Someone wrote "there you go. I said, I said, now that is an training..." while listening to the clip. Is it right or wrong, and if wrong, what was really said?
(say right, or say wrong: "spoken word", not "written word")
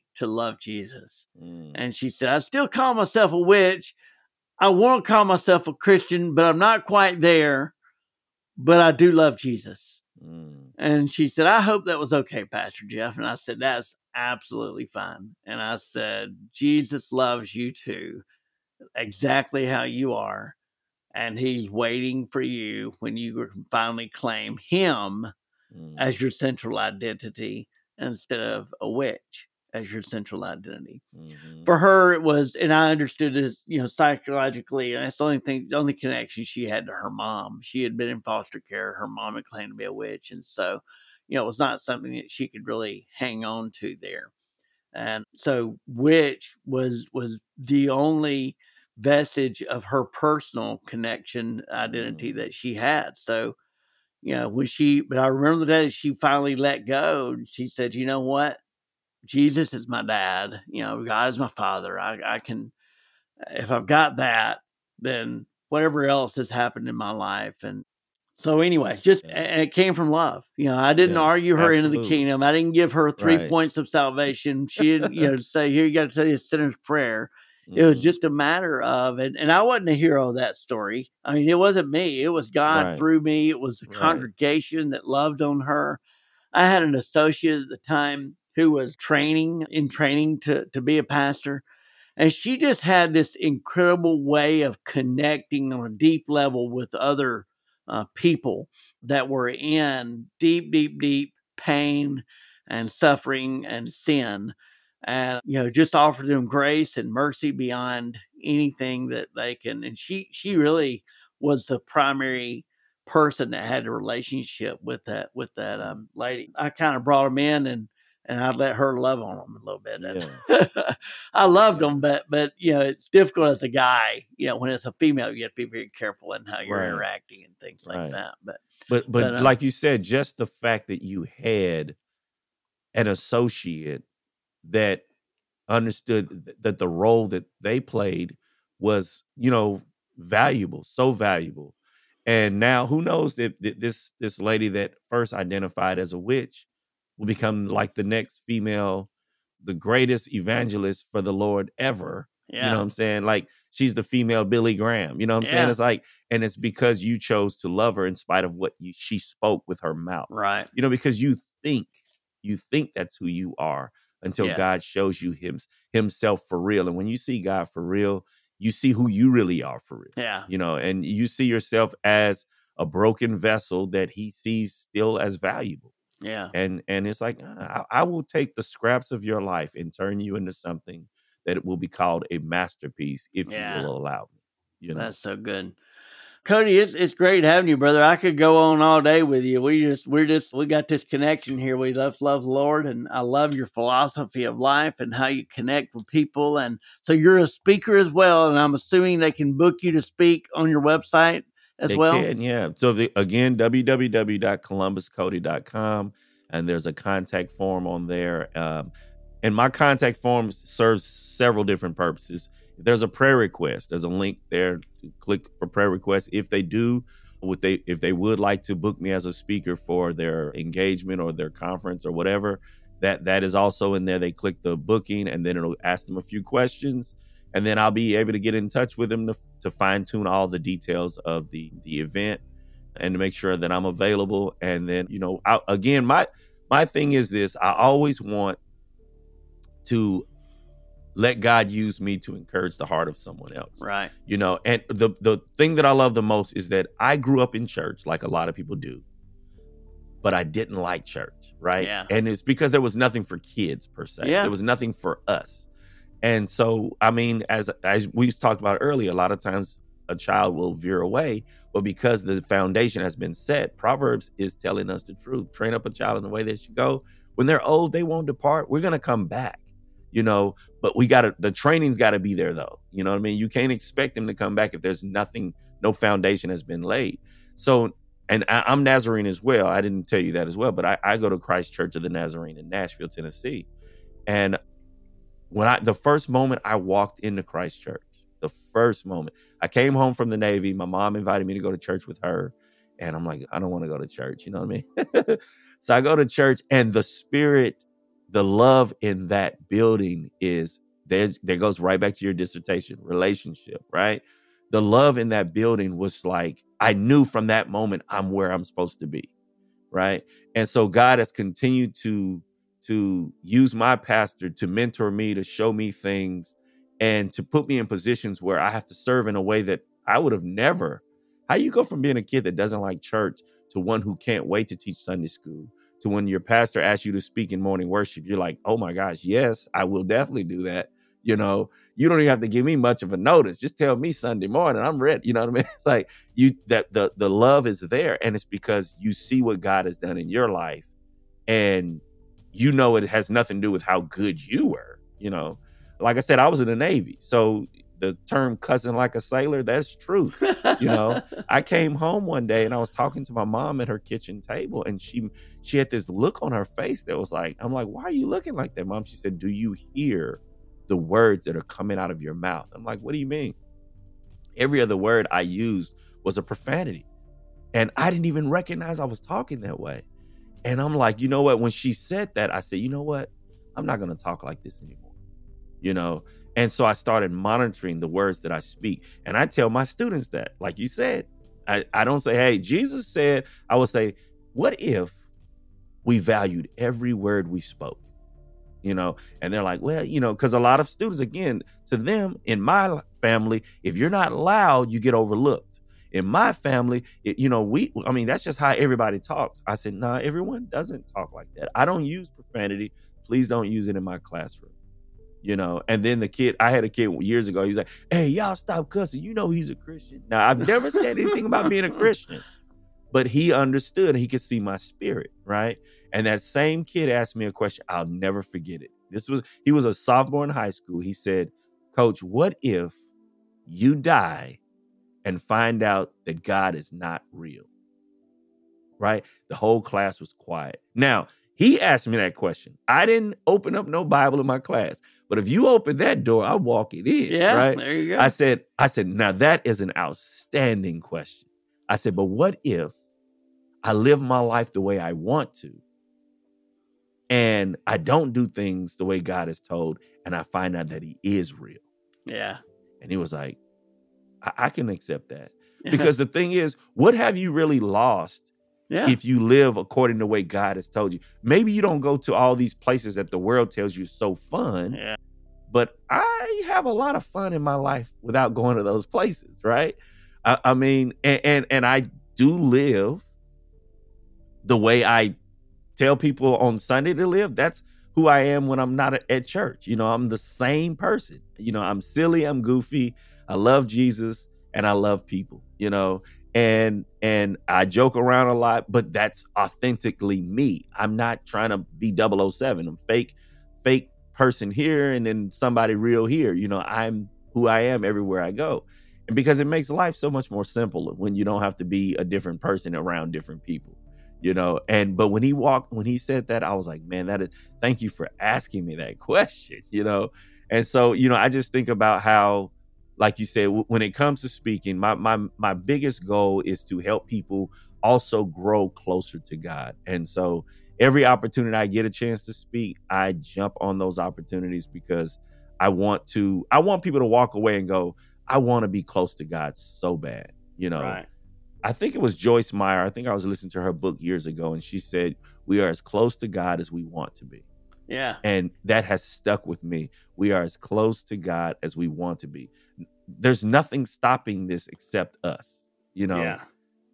wrong: "outstanding", not "training".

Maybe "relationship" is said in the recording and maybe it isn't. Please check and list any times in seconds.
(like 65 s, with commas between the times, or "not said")
113 s, 303 s.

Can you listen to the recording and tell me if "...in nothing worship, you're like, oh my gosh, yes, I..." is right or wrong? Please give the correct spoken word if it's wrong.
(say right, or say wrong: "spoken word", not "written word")
wrong: "morning", not "nothing".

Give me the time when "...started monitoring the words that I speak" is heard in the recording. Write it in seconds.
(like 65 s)
376 s.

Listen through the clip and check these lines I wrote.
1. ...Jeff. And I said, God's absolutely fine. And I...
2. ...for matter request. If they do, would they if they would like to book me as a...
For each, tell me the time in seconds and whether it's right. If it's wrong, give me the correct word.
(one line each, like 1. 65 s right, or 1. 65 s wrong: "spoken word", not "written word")
1. 12 s wrong: "That", not "God"
2. 215 s wrong: "prayer", not "matter".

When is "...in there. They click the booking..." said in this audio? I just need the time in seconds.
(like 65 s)
223 s.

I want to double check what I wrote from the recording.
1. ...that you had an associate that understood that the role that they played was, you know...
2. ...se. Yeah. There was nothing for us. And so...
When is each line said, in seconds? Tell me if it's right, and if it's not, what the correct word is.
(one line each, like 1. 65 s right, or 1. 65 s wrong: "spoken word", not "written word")
1. 130 s right
2. 254 s right.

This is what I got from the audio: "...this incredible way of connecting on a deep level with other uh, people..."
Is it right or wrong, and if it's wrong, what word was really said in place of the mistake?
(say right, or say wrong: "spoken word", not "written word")
right.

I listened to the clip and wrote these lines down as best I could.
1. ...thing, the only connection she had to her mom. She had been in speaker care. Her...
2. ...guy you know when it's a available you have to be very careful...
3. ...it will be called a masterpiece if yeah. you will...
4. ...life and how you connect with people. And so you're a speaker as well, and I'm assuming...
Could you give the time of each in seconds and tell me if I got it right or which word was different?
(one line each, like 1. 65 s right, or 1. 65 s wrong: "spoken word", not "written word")
1. 35 s wrong: "foster", not "speaker"
2. 123 s wrong: "female", not "available"
3. 181 s right
4. 194 s right.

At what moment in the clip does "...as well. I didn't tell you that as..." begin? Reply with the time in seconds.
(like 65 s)
279 s.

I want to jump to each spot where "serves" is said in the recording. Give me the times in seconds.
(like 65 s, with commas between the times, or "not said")
210 s, 318 s.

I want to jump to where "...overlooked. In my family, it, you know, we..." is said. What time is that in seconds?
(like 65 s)
395 s.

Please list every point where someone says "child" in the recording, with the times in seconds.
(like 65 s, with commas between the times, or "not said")
260 s, 265 s.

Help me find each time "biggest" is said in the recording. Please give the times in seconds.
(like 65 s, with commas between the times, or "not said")
515 s.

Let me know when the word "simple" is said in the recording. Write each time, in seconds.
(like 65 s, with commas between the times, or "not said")
500 s.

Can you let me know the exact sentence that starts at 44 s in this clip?
And so, witch was was the only vestige of her personal connection identity mm.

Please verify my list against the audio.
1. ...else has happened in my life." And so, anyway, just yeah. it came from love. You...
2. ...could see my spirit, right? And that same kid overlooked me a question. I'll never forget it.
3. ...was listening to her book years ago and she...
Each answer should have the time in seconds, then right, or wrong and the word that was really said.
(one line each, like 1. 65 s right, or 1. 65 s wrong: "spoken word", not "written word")
1. 66 s right
2. 414 s wrong: "asked", not "overlooked"
3. 533 s right.